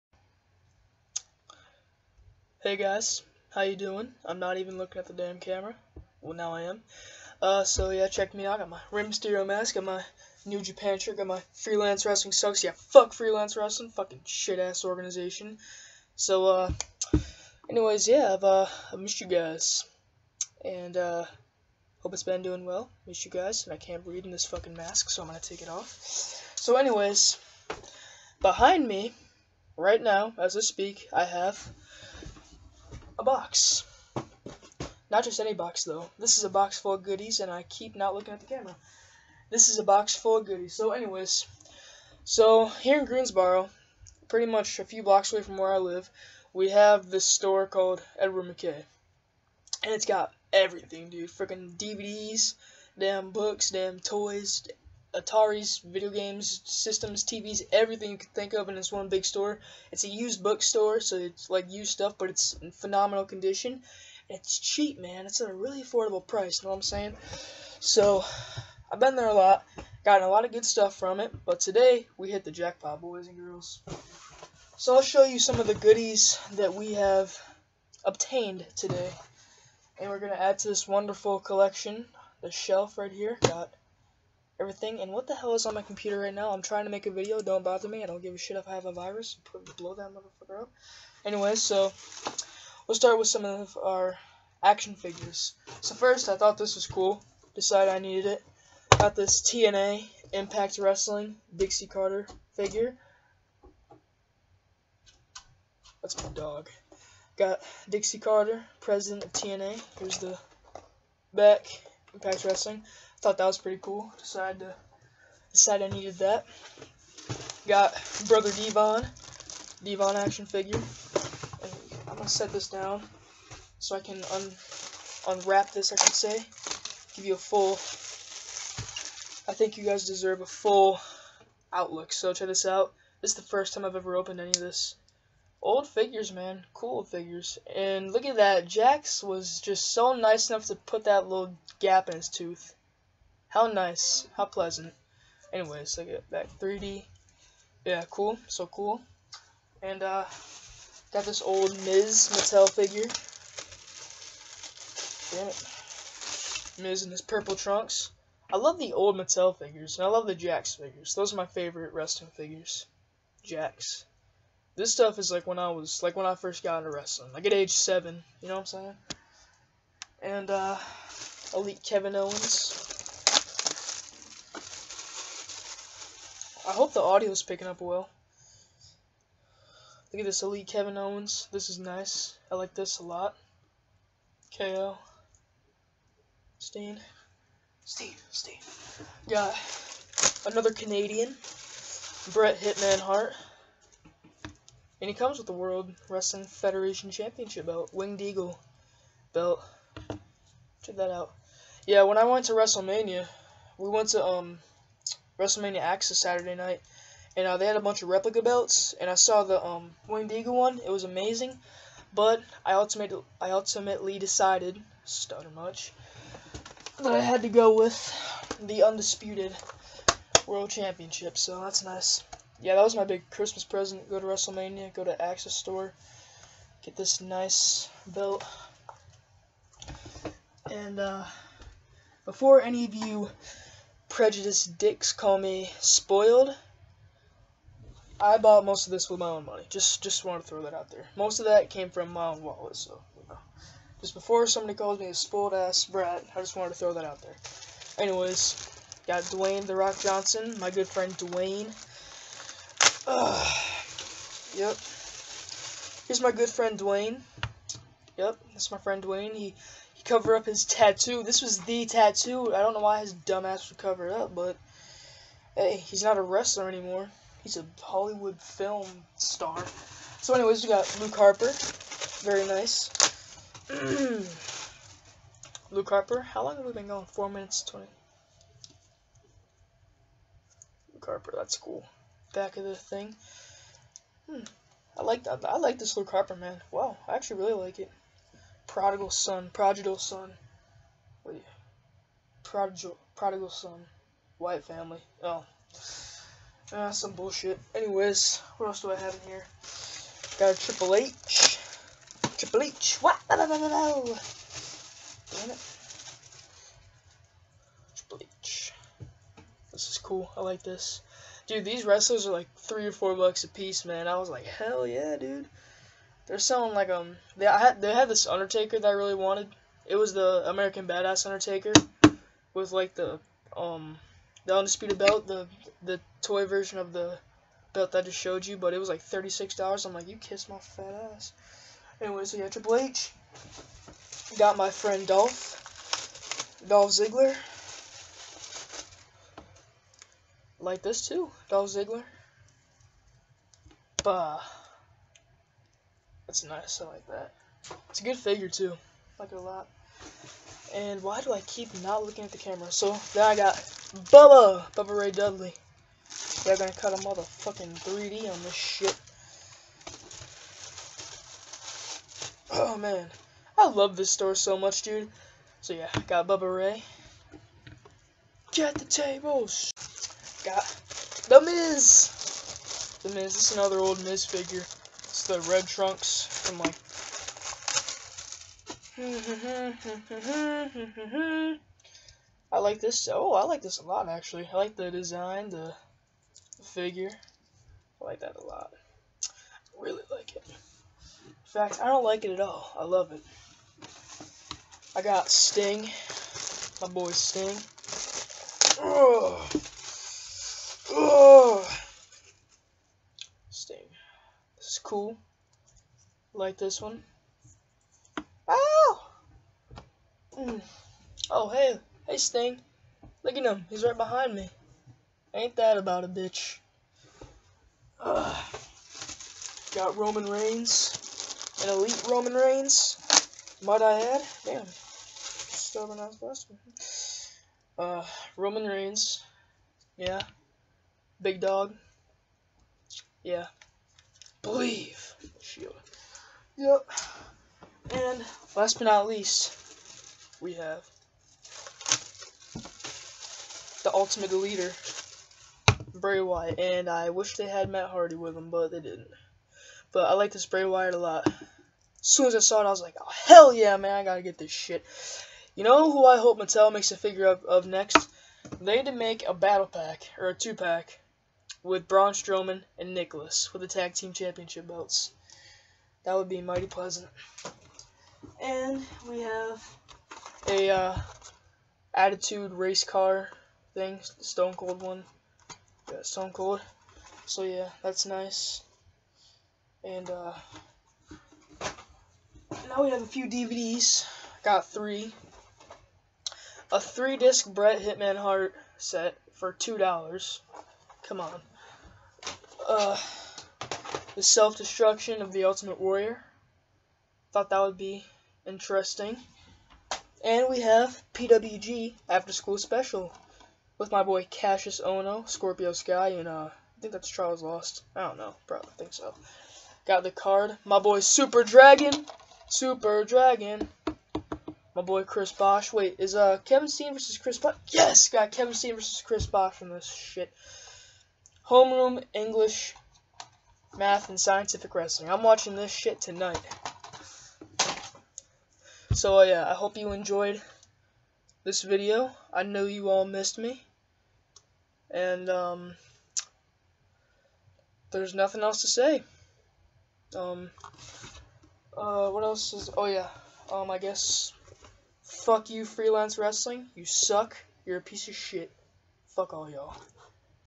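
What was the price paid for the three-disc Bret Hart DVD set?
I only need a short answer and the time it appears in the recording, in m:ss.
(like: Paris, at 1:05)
$2, at 8:09.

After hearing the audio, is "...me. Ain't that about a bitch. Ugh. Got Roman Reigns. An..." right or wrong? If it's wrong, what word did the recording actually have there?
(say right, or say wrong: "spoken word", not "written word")
right.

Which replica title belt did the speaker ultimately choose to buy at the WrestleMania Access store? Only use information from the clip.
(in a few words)
undisputed World Championship.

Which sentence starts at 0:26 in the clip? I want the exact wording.
So anyways, behind me, right now, as I speak, I have a box.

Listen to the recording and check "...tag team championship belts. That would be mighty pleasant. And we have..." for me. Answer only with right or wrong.
right.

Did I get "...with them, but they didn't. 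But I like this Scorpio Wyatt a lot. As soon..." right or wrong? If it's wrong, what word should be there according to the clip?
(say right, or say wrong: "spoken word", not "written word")
wrong: "Bray", not "Scorpio".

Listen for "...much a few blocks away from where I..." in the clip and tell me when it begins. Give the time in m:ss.
0:44.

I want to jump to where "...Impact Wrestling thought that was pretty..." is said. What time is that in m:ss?
1:52.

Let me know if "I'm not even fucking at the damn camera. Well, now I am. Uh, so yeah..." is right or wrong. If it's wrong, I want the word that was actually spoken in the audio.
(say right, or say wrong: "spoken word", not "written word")
wrong: "looking", not "fucking".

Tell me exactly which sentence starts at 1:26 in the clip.
I'm trying to make a video.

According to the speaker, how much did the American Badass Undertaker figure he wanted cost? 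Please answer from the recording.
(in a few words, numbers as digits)
$36.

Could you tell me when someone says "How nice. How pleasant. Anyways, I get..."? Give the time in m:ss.
2:23.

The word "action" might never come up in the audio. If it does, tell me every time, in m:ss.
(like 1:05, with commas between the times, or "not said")
1:34, 2:00.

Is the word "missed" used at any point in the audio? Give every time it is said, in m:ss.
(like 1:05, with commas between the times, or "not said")
0:18, 0:23, 8:53.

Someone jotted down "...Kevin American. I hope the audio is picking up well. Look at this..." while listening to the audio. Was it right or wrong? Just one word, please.
wrong.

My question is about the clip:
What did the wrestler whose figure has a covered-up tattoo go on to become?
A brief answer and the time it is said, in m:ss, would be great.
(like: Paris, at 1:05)
Hollywood film star, at 4:27.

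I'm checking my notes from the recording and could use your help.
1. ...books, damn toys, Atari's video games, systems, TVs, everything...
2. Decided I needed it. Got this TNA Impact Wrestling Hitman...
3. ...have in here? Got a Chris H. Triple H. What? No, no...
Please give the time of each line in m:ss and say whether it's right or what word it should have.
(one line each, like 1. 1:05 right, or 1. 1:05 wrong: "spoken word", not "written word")
1. 0:53 right
2. 1:37 wrong: "Dixie", not "Hitman"
3. 4:58 wrong: "Triple", not "Chris".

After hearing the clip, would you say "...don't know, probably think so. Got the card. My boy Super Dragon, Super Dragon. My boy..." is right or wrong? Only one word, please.
right.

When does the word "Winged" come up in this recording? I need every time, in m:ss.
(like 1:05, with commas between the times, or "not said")
3:17, 3:30.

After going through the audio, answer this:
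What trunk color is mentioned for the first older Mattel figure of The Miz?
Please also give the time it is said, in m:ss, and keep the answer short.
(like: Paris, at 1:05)
purple, at 2:37.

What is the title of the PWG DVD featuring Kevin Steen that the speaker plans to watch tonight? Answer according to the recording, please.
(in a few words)
After School Special.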